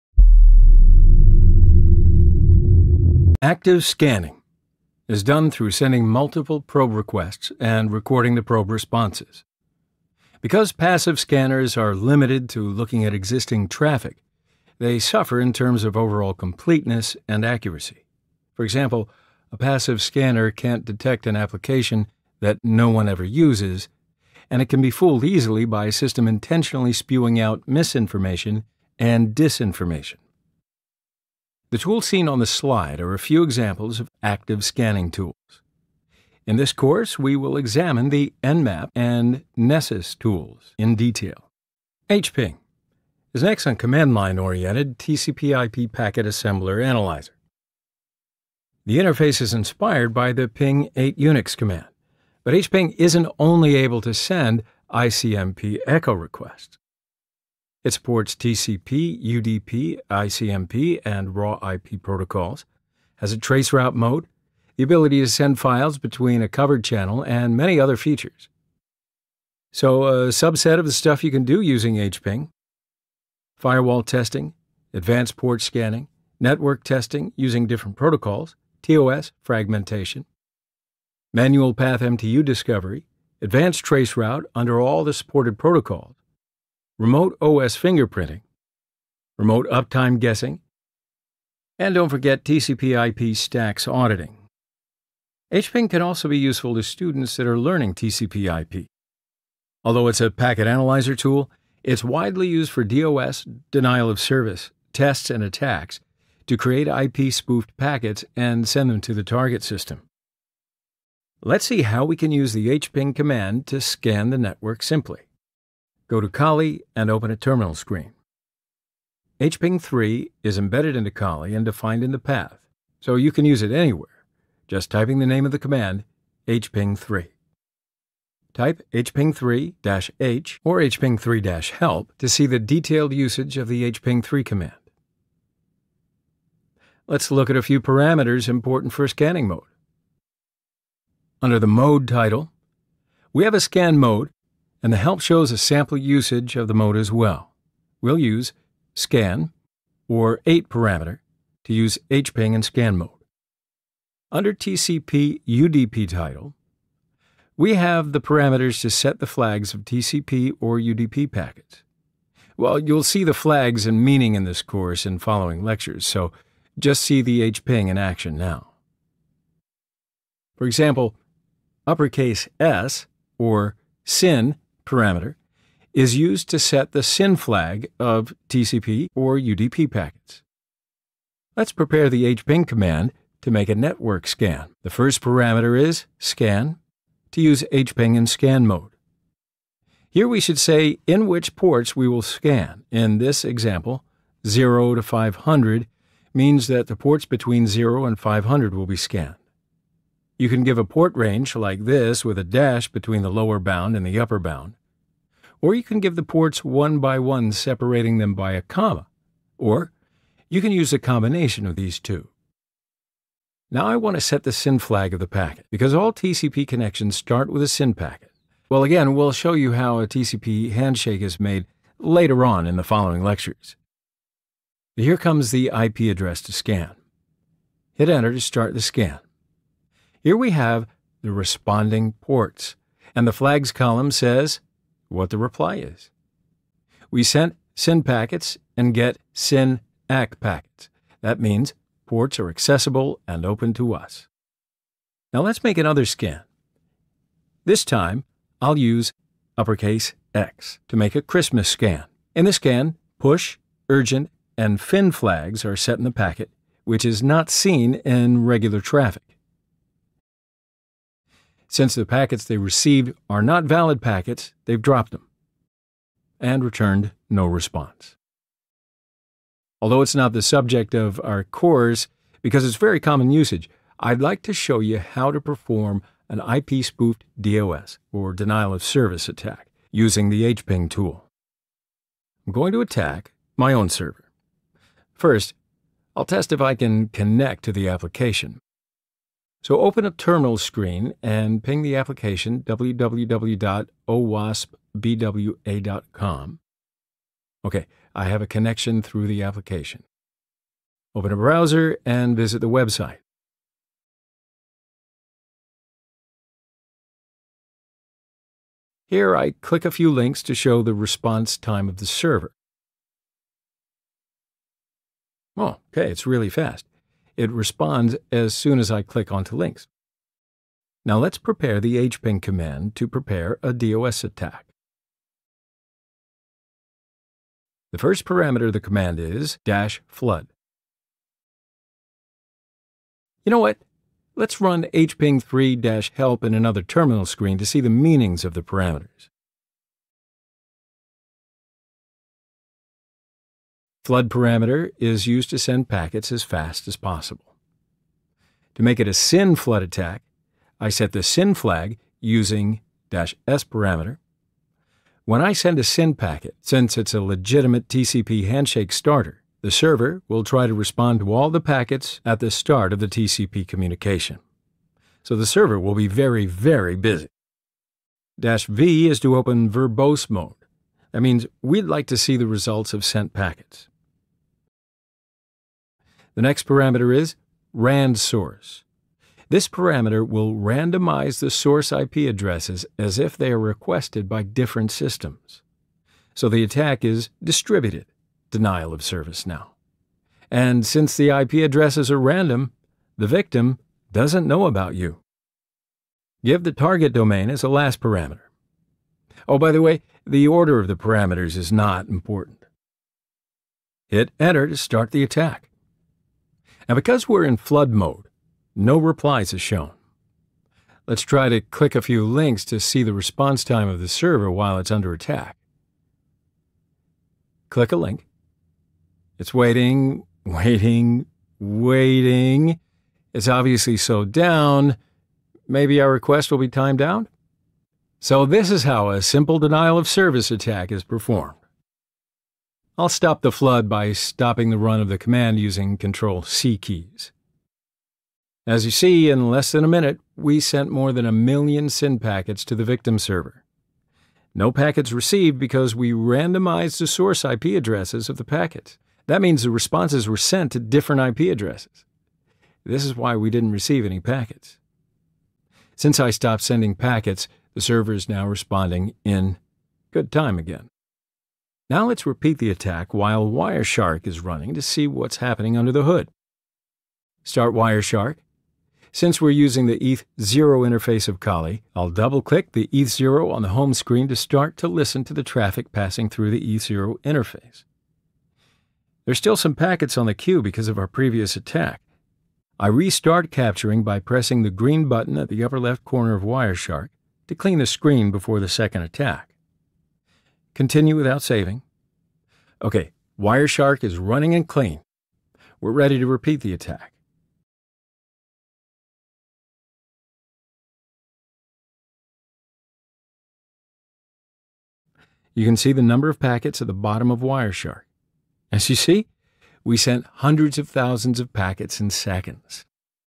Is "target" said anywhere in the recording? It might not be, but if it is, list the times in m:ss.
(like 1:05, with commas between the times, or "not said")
1:49, 6:36.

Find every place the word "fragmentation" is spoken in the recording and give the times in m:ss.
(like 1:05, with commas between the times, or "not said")
1:19.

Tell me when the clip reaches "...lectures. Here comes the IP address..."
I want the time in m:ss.
3:43.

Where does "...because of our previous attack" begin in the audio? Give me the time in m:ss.
8:00.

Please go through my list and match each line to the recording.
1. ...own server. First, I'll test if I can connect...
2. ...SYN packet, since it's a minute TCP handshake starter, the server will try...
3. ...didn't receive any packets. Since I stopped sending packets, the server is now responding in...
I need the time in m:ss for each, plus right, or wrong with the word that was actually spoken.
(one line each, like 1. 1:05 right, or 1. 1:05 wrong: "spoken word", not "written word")
1. 4:43 right
2. 5:55 wrong: "legitimate", not "minute"
3. 7:33 right.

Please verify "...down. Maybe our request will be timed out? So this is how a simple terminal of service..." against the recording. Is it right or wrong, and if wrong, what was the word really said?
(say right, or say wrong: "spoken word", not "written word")
wrong: "denial", not "terminal".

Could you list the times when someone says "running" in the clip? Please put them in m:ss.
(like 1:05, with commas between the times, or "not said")
7:44, 8:14.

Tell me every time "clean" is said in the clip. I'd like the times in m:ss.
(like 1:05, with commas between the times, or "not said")
8:07, 8:14.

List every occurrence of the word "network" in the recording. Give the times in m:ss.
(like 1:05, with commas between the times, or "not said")
1:16, 1:54, 3:03.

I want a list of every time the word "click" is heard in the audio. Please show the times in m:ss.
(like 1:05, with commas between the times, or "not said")
5:09, 5:19, 6:51, 6:57, 7:52.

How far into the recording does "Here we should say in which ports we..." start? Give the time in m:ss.
3:10.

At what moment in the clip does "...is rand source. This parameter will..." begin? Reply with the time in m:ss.
6:17.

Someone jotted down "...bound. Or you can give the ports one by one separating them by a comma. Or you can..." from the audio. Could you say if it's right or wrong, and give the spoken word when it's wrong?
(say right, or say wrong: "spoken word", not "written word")
right.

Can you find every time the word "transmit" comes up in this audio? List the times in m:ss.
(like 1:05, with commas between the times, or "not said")
not said.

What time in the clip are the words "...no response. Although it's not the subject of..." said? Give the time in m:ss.
4:27.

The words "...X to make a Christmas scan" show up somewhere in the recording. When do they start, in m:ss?
4:10.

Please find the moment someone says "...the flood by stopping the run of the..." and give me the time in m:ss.
7:13.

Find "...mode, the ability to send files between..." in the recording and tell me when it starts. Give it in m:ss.
1:03.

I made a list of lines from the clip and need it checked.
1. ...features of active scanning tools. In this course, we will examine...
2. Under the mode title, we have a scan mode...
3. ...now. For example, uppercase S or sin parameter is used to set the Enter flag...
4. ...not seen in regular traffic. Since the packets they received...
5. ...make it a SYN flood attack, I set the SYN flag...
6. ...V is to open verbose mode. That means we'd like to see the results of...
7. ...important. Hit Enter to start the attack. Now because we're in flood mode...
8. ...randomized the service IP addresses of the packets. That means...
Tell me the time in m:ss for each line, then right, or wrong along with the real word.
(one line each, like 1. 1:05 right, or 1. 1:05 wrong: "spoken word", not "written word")
1. 0:33 wrong: "examples", not "features"
2. 2:21 right
3. 2:48 wrong: "SYN", not "Enter"
4. 4:17 right
5. 5:48 right
6. 6:08 right
7. 6:42 right
8. 7:26 wrong: "source", not "service".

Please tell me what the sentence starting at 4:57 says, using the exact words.
Okay, I have a connection through the application.